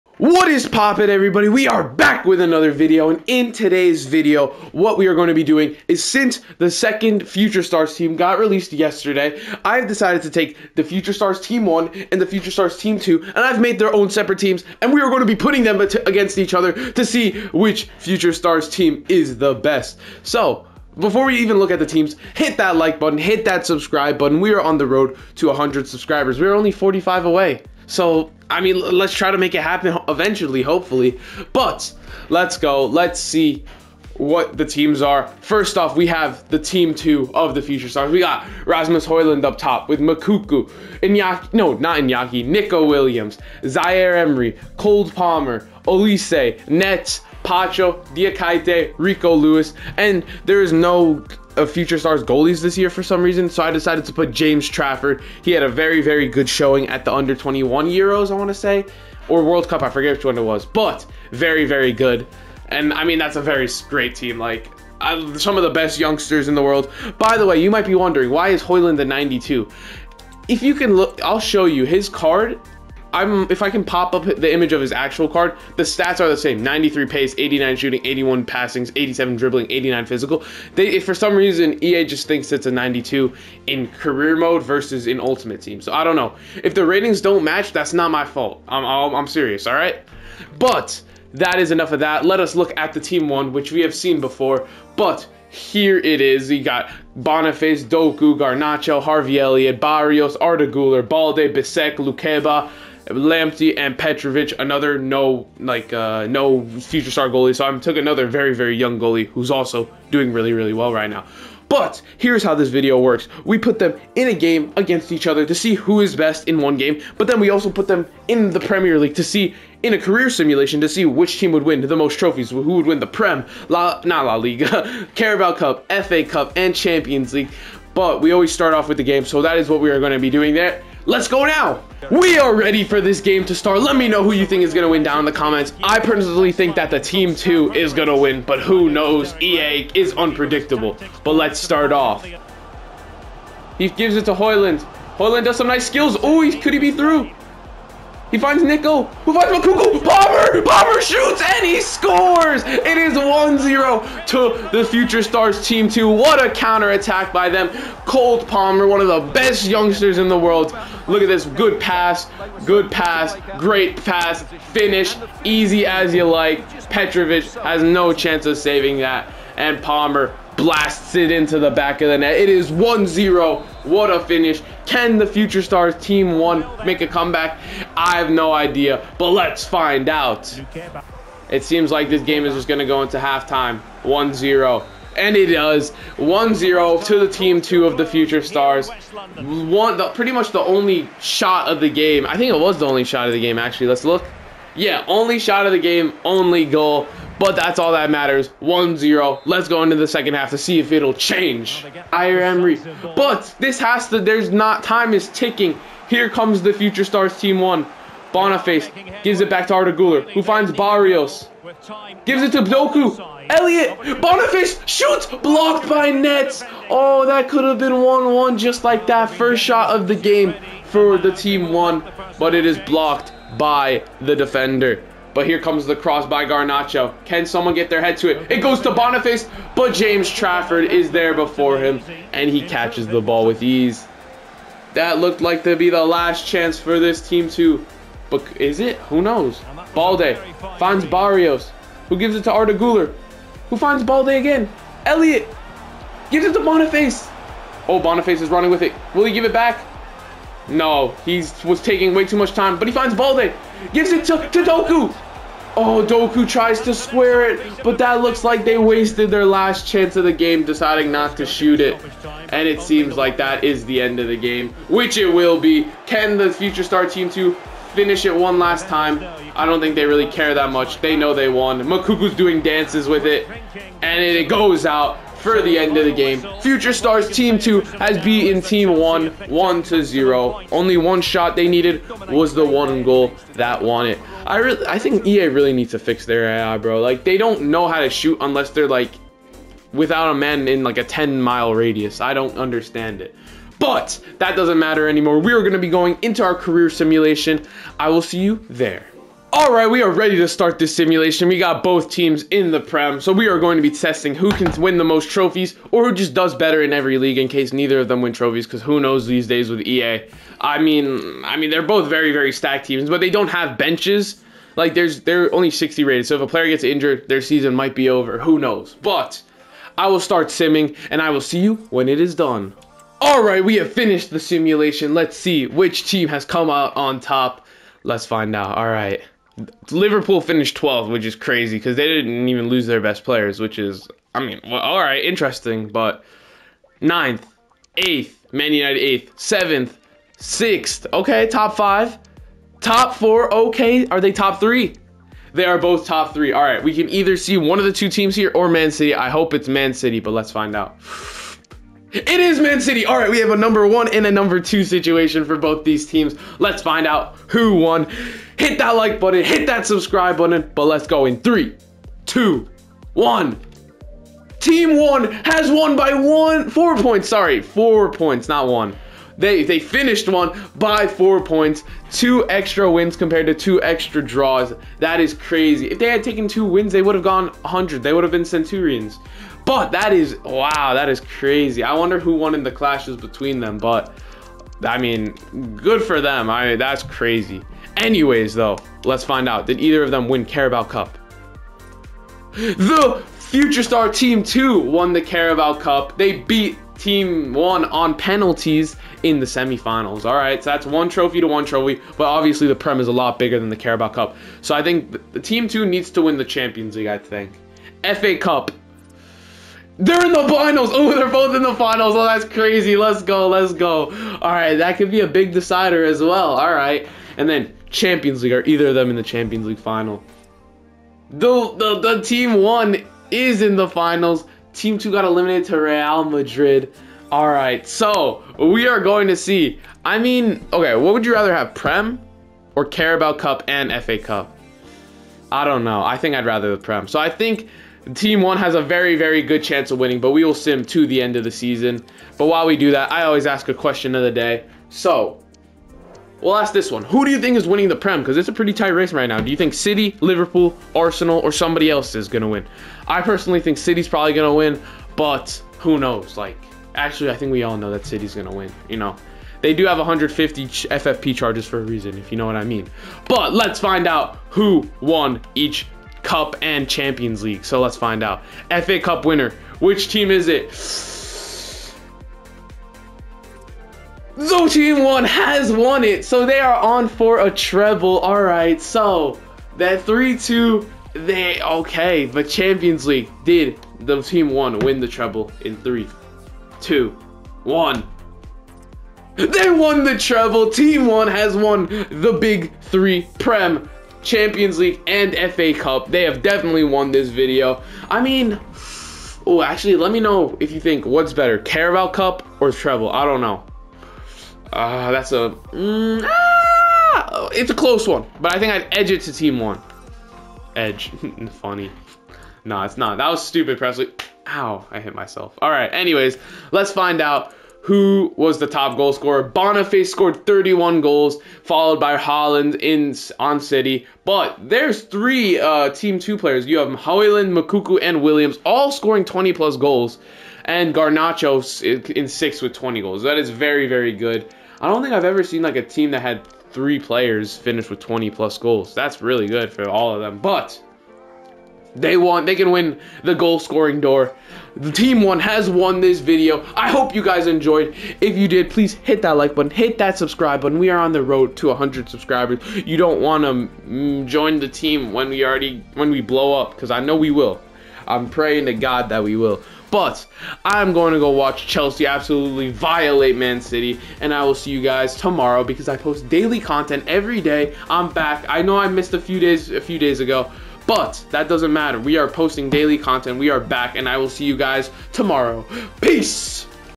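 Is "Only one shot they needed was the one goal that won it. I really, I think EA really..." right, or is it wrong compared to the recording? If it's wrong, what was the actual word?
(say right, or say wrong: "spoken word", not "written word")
right.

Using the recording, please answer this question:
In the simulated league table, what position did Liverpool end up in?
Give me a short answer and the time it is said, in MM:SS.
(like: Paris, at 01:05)
12th, at 05:30.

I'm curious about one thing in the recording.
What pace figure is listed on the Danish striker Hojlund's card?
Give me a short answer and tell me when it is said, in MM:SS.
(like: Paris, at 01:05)
93, at 01:16.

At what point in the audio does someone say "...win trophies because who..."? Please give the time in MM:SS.
05:08.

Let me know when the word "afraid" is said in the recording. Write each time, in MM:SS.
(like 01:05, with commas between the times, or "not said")
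not said.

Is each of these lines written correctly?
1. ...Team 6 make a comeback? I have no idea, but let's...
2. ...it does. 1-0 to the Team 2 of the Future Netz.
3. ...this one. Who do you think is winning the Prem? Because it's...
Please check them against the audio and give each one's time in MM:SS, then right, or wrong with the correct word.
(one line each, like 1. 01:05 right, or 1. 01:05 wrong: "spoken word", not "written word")
1. 02:56 wrong: "1", not "6"
2. 03:05 wrong: "Stars", not "Netz"
3. 07:26 right.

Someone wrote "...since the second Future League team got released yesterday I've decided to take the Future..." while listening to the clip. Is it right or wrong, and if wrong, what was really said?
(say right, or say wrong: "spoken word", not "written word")
wrong: "Stars", not "League".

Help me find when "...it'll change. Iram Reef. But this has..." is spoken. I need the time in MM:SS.
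03:20.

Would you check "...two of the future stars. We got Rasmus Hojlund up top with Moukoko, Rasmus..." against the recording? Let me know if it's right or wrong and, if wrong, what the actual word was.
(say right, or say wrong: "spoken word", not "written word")
wrong: "Iñaki", not "Rasmus".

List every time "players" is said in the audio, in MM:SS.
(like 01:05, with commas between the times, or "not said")
05:16, 05:33, 08:46, 08:56.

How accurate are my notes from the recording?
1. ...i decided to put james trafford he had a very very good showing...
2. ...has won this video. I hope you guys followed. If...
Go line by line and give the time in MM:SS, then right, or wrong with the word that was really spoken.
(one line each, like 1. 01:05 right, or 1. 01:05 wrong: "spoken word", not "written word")
1. 00:53 right
2. 09:05 wrong: "enjoyed", not "followed".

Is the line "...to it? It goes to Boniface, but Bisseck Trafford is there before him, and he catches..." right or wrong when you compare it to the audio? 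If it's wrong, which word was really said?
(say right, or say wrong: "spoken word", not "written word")
wrong: "James", not "Bisseck".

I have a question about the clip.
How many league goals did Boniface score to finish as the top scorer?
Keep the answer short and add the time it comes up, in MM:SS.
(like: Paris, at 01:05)
31, at 08:40.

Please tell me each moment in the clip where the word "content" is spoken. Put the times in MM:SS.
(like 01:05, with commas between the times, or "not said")
09:26, 09:32.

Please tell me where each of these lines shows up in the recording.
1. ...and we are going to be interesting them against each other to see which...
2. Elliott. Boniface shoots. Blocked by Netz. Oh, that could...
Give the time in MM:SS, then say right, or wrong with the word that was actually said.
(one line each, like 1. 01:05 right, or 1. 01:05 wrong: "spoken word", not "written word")
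1. 00:14 wrong: "putting", not "interesting"
2. 03:33 right.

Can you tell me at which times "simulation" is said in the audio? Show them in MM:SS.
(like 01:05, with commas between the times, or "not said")
02:00, 04:56, 05:00, 05:24.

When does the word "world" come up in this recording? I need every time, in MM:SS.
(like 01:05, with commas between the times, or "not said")
00:59, 01:06, 02:40.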